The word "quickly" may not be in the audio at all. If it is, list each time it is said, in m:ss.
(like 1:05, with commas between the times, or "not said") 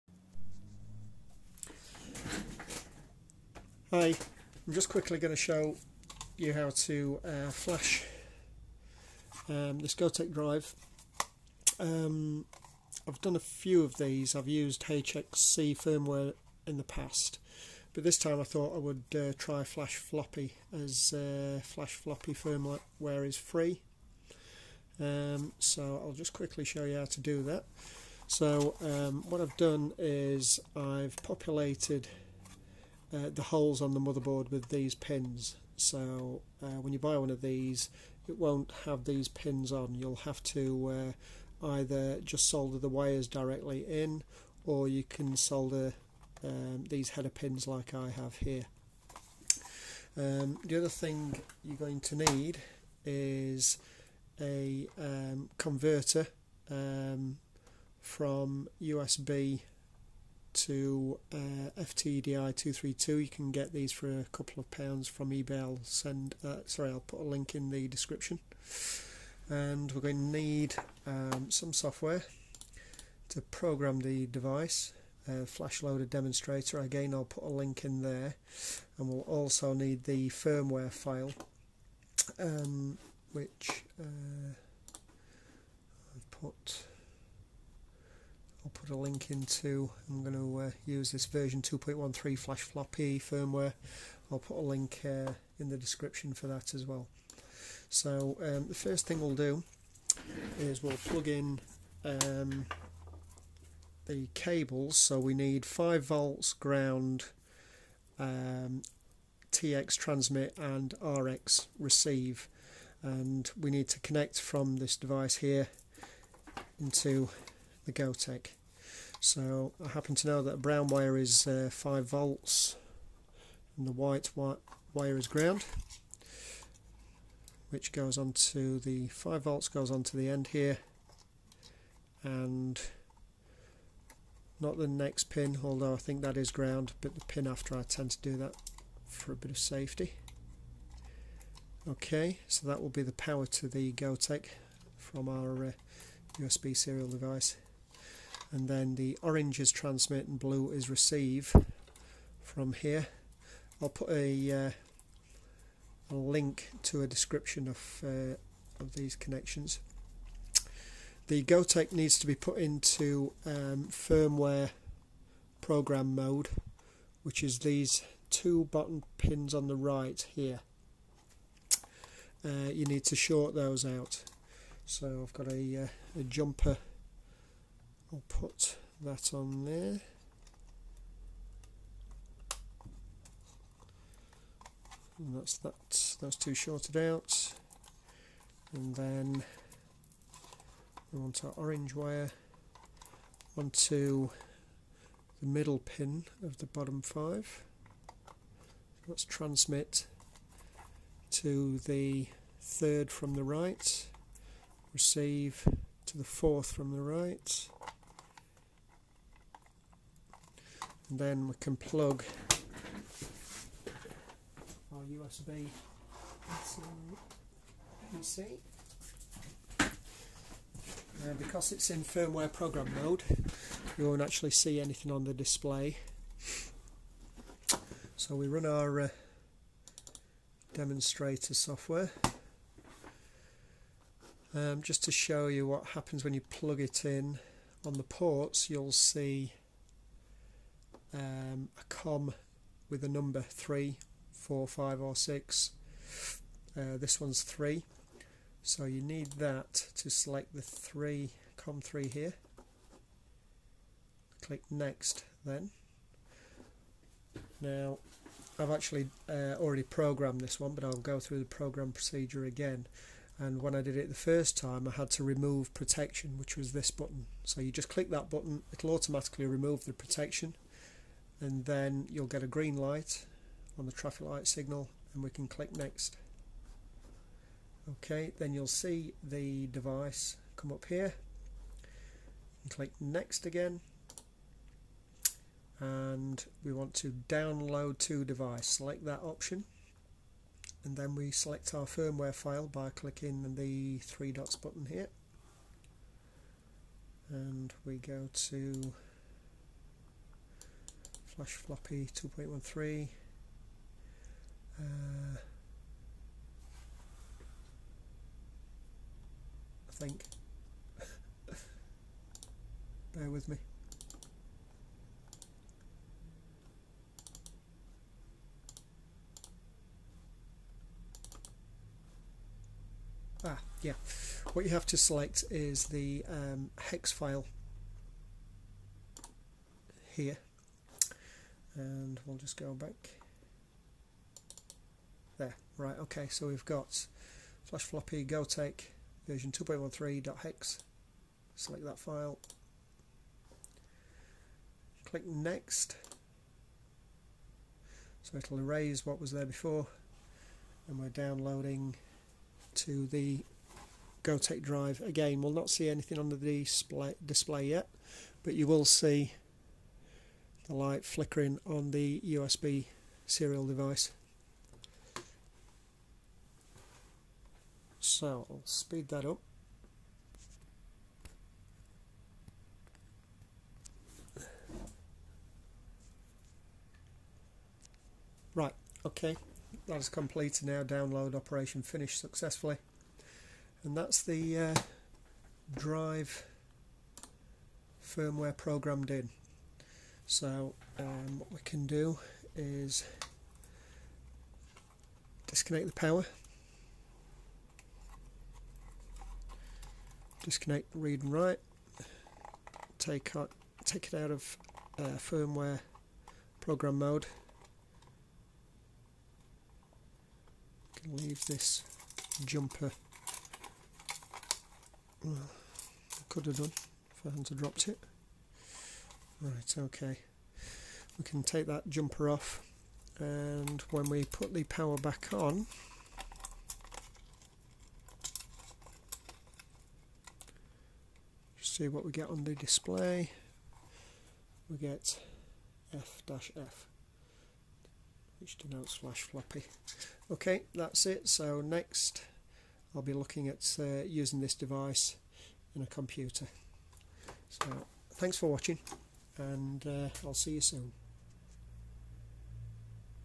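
0:04, 0:26.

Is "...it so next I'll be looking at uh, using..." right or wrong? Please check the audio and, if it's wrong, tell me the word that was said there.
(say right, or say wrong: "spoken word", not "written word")
right.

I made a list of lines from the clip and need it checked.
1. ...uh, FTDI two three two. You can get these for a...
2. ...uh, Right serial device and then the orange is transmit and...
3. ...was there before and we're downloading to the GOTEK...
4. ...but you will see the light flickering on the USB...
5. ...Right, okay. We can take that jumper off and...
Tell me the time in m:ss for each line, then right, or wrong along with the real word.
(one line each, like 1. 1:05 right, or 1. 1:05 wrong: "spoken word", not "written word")
1. 1:01 right
2. 2:25 wrong: "USB", not "Right"
3. 5:49 right
4. 5:58 right
5. 6:59 right.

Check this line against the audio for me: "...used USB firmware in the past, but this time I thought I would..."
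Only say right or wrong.
wrong.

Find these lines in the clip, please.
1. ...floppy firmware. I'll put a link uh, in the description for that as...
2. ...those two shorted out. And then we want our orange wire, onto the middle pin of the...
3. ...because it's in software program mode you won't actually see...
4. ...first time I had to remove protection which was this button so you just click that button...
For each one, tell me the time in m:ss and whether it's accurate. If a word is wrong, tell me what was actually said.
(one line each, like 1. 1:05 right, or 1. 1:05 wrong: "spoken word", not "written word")
1. 1:32 right
2. 3:06 right
3. 3:41 wrong: "firmware", not "software"
4. 4:24 right.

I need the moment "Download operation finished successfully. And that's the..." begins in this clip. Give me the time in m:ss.
6:20.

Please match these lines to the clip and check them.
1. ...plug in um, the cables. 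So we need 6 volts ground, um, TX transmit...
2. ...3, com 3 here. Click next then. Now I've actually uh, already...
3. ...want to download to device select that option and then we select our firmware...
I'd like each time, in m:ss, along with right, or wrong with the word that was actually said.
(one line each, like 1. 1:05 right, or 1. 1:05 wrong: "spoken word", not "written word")
1. 1:41 wrong: "5", not "6"
2. 4:10 right
3. 4:46 right.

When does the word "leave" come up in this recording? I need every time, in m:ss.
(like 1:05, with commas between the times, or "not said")
6:51.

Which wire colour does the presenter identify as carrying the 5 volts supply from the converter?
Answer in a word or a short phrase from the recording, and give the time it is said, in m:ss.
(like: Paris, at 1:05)
Brown, at 2:00.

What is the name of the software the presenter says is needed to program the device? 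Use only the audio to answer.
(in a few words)
Flash Loader Demonstrator.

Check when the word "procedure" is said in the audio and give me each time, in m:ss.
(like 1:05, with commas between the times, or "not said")
4:21.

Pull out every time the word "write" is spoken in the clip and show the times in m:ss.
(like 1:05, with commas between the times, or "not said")
6:41.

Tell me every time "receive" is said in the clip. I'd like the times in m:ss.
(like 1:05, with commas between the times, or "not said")
1:51, 2:30, 3:24.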